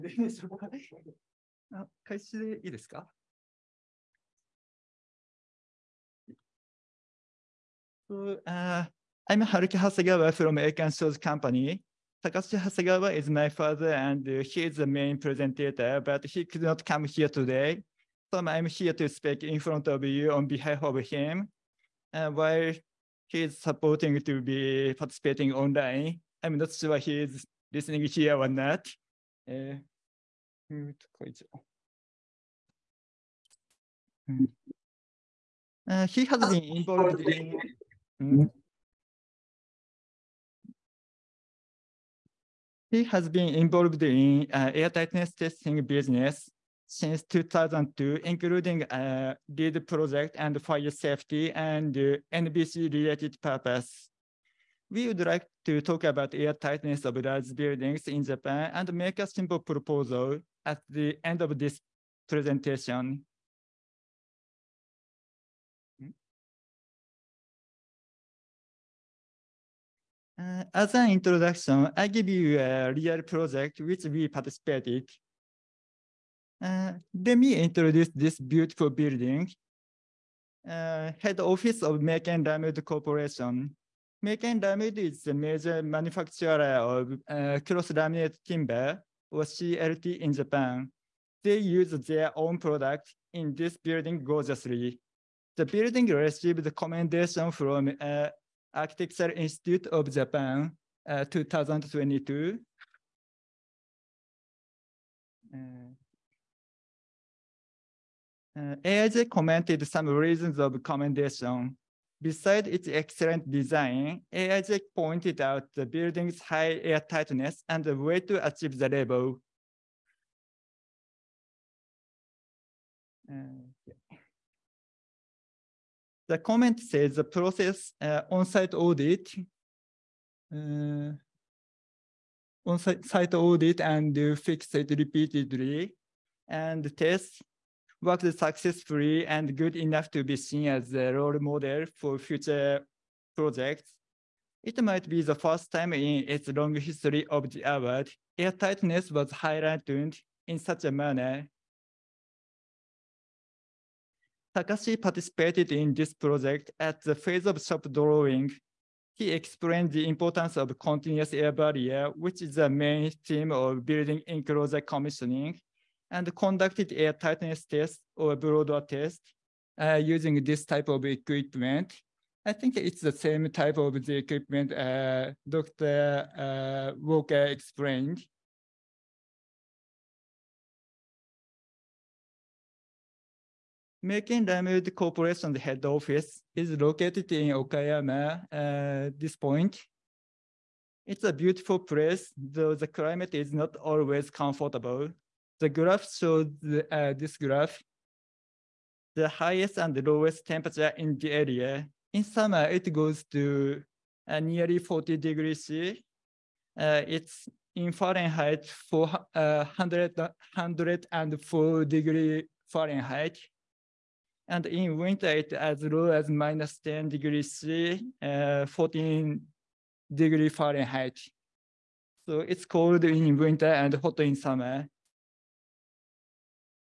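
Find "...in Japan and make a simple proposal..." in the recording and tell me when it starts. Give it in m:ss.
0:58.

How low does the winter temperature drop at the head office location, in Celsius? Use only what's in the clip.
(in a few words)
-10 degrees C.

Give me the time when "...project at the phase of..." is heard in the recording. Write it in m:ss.
2:36.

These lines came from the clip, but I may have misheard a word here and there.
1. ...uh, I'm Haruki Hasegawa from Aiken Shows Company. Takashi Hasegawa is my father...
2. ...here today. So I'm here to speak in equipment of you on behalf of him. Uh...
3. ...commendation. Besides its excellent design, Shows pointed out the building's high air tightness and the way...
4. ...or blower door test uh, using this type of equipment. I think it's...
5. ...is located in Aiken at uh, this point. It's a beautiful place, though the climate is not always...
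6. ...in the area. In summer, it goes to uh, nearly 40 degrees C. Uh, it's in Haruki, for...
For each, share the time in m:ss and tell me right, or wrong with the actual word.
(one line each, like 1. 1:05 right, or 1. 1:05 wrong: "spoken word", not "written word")
1. 0:08 right
2. 0:17 wrong: "front", not "equipment"
3. 1:50 wrong: "AIJ", not "Shows"
4. 2:48 right
5. 3:06 wrong: "Okayama", not "Aiken"
6. 3:20 wrong: "Fahrenheit", not "Haruki".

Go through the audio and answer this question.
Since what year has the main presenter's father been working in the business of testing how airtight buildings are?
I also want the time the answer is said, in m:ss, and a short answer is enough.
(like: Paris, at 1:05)
2002, at 0:47.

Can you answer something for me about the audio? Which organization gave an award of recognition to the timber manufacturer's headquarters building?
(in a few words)
Architectural Institute of Japan.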